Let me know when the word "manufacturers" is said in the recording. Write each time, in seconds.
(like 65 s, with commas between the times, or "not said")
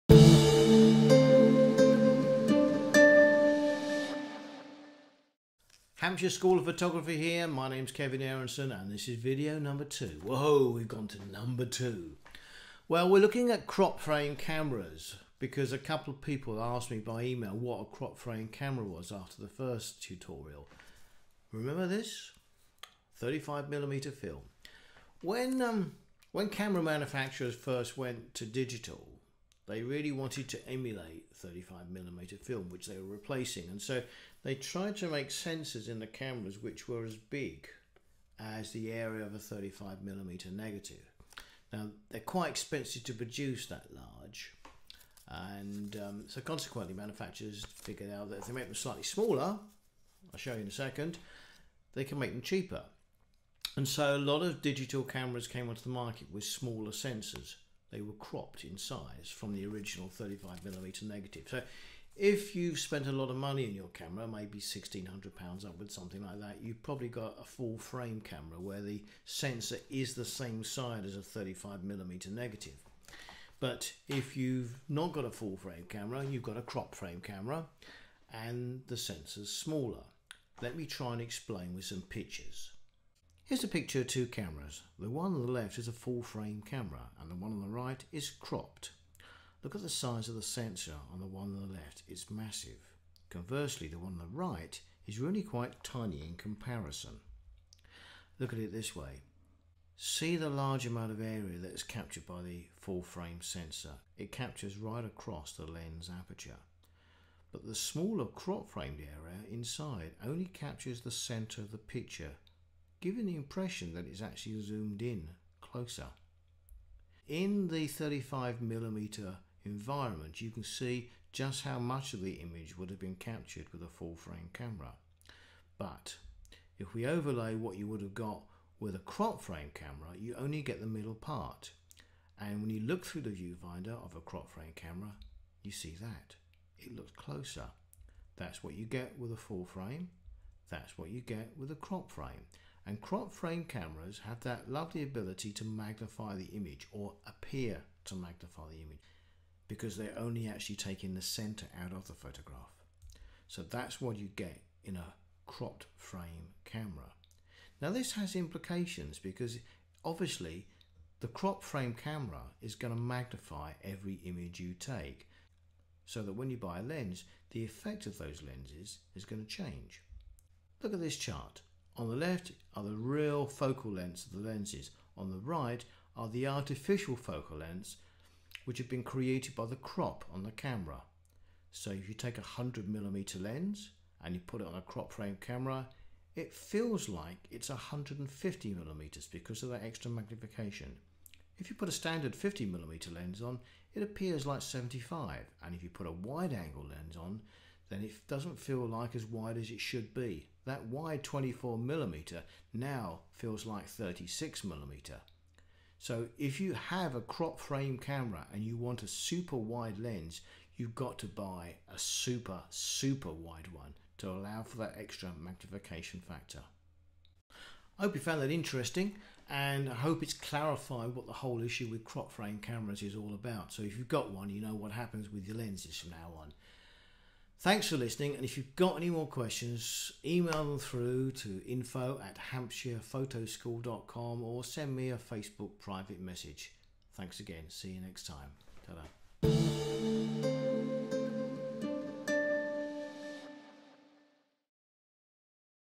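26 s, 46 s.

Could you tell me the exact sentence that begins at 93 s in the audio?
Conversely, the one on the right is really quite tiny in comparison.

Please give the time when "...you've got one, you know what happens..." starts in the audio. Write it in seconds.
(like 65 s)
223 s.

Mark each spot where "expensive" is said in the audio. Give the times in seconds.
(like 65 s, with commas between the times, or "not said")
42 s.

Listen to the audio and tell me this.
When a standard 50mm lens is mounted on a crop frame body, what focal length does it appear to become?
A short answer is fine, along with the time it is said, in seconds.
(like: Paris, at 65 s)
75, at 194 s.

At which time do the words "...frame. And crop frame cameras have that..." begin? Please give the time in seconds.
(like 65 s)
142 s.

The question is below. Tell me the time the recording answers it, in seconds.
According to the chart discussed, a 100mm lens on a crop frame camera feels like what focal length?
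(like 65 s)
187 s.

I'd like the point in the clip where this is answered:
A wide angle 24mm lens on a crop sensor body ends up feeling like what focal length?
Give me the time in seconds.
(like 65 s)
203 s.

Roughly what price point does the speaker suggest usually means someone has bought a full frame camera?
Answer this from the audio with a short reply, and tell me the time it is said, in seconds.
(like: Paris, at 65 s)
£1,600, at 64 s.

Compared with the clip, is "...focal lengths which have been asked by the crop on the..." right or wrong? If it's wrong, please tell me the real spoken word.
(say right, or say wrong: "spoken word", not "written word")
wrong: "created", not "asked".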